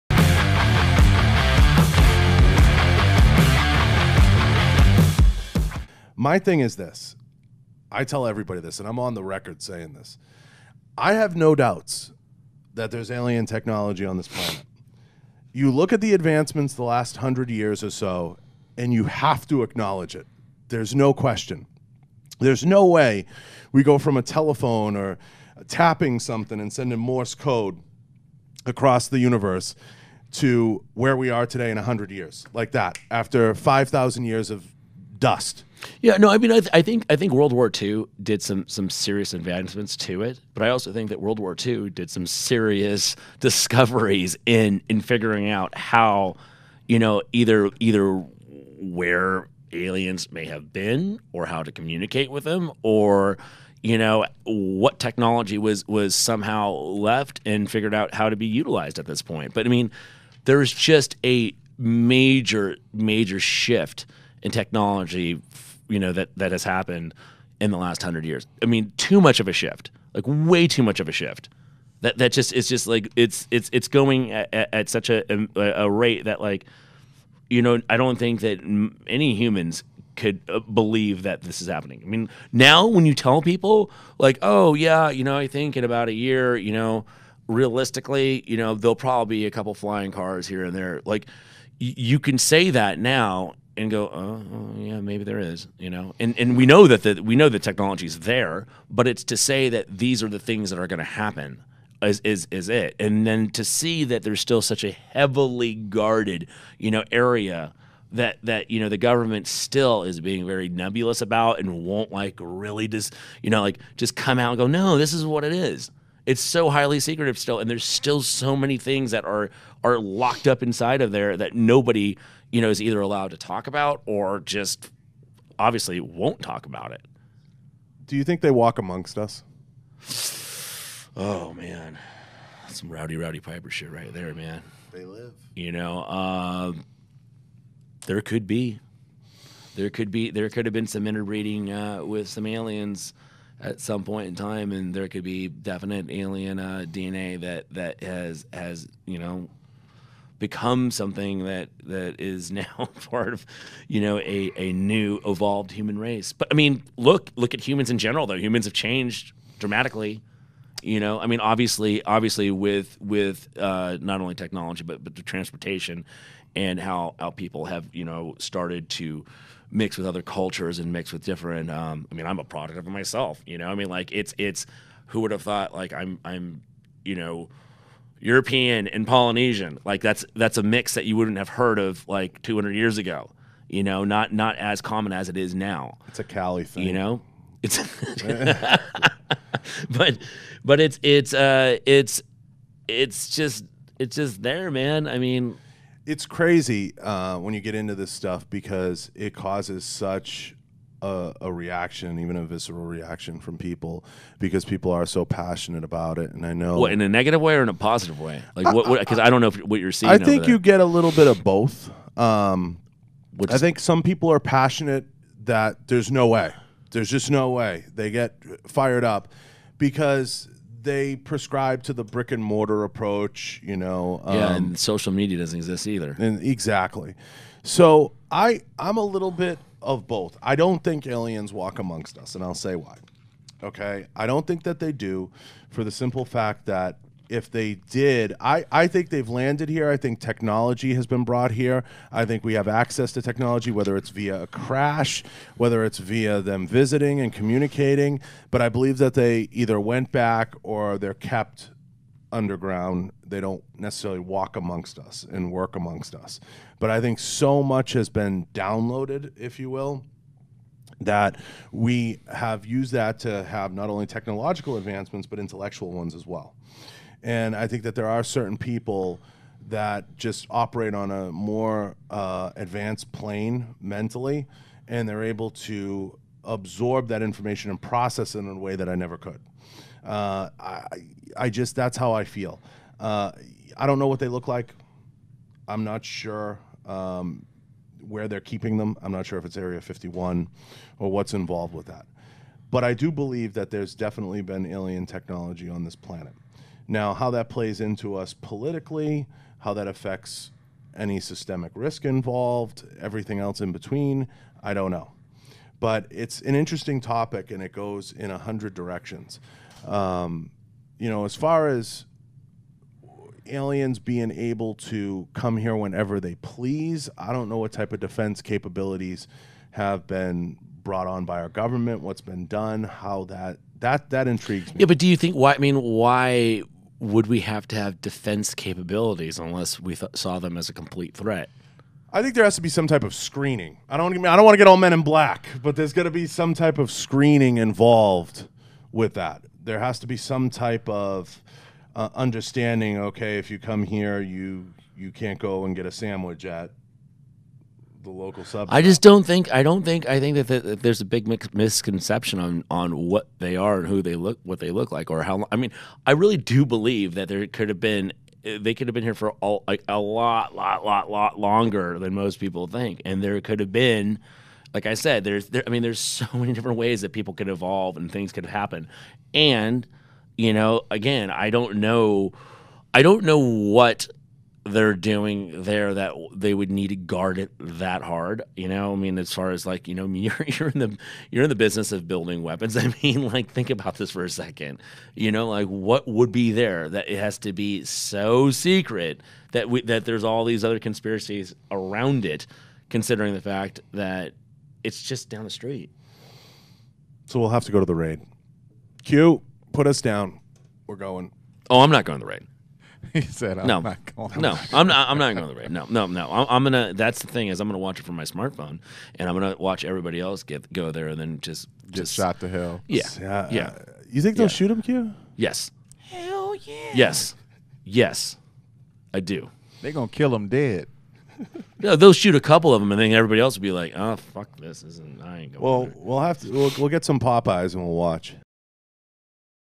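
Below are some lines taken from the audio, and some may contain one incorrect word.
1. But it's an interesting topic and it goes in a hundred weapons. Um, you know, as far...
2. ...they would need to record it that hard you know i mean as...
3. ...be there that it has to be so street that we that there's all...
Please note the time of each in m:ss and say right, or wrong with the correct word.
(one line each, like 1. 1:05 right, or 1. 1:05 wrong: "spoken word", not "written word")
1. 5:05 wrong: "directions", not "weapons"
2. 6:16 wrong: "guard", not "record"
3. 6:26 wrong: "secret", not "street".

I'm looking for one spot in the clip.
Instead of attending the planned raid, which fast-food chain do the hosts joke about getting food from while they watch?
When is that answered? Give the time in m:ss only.
7:07.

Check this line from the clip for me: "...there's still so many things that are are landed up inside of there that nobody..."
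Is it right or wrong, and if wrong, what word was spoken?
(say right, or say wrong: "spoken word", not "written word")
wrong: "locked", not "landed".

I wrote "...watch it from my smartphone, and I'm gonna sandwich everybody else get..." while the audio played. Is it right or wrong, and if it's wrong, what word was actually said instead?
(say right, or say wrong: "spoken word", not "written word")
wrong: "watch", not "sandwich".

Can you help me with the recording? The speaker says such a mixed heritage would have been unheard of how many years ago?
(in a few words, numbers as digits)
200.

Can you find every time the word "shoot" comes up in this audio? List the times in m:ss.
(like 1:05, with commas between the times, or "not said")
6:54, 7:02.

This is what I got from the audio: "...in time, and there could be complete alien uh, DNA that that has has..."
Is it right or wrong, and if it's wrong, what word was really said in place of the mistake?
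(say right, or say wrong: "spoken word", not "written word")
wrong: "definite", not "complete".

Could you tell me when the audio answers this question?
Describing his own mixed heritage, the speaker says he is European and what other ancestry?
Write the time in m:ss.
2:59.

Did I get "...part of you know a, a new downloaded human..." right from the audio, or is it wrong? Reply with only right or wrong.
wrong.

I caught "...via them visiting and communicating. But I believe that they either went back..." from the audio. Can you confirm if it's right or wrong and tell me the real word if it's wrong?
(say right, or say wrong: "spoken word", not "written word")
right.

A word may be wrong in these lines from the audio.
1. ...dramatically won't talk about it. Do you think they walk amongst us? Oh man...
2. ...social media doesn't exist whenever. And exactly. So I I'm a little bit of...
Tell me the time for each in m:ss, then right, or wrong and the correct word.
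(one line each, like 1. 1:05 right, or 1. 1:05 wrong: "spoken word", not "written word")
1. 2:05 wrong: "obviously", not "dramatically"
2. 3:44 wrong: "either", not "whenever".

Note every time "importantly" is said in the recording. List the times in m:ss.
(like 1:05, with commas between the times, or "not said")
not said.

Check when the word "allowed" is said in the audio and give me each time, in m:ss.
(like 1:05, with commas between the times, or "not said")
2:03.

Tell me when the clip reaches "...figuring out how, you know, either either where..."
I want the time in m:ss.
0:45.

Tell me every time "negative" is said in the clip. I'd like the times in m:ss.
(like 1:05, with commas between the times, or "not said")
3:27.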